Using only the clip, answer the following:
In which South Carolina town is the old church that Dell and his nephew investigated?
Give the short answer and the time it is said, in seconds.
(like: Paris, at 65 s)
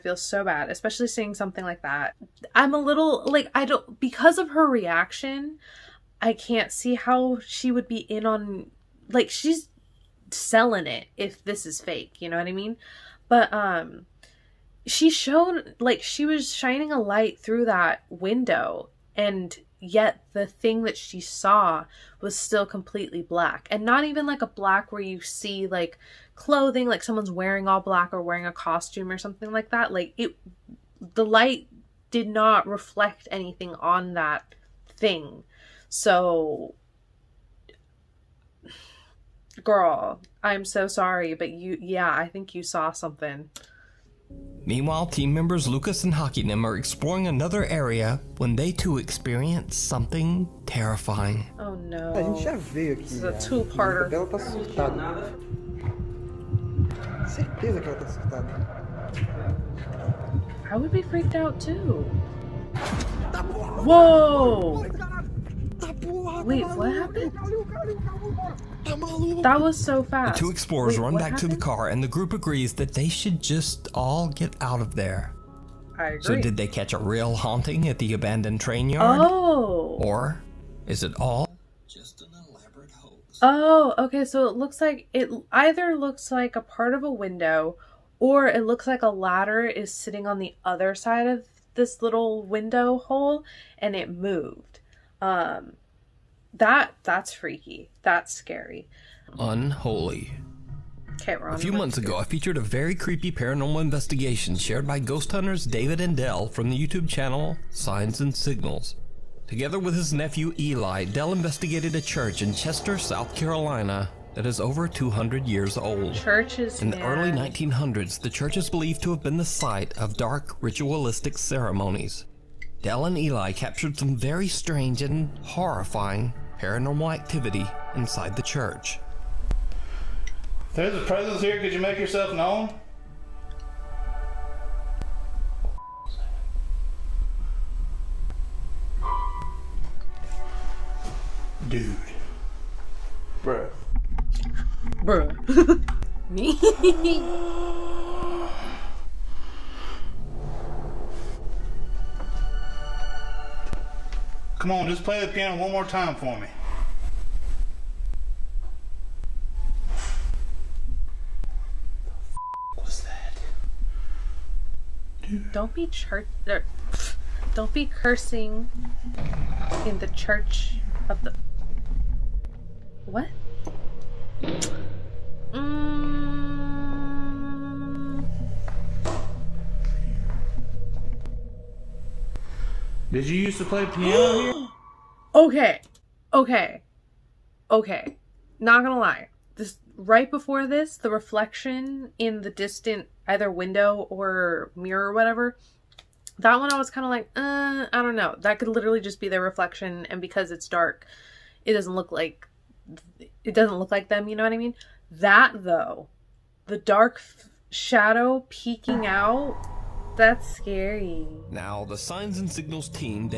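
Chester, at 112 s.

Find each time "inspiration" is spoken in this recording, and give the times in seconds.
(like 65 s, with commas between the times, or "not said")
not said.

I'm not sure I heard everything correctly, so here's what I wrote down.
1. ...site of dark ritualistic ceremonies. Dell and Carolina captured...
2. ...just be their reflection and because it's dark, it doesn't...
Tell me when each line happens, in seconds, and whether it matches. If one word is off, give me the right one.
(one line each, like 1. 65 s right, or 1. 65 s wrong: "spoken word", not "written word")
1. 119 s wrong: "Eli", not "Carolina"
2. 199 s right.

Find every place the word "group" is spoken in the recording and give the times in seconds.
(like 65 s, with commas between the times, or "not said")
72 s.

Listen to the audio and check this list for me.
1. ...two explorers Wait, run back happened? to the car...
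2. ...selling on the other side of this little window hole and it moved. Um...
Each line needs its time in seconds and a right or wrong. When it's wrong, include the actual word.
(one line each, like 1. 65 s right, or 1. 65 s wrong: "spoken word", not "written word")
1. 70 s right
2. 89 s wrong: "sitting", not "selling".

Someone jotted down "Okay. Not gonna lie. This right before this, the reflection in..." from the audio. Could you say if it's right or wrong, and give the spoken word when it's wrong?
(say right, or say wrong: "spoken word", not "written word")
right.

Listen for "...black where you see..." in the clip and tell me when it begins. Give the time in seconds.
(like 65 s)
24 s.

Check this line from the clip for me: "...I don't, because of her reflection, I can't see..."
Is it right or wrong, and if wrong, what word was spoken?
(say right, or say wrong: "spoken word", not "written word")
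wrong: "reaction", not "reflection".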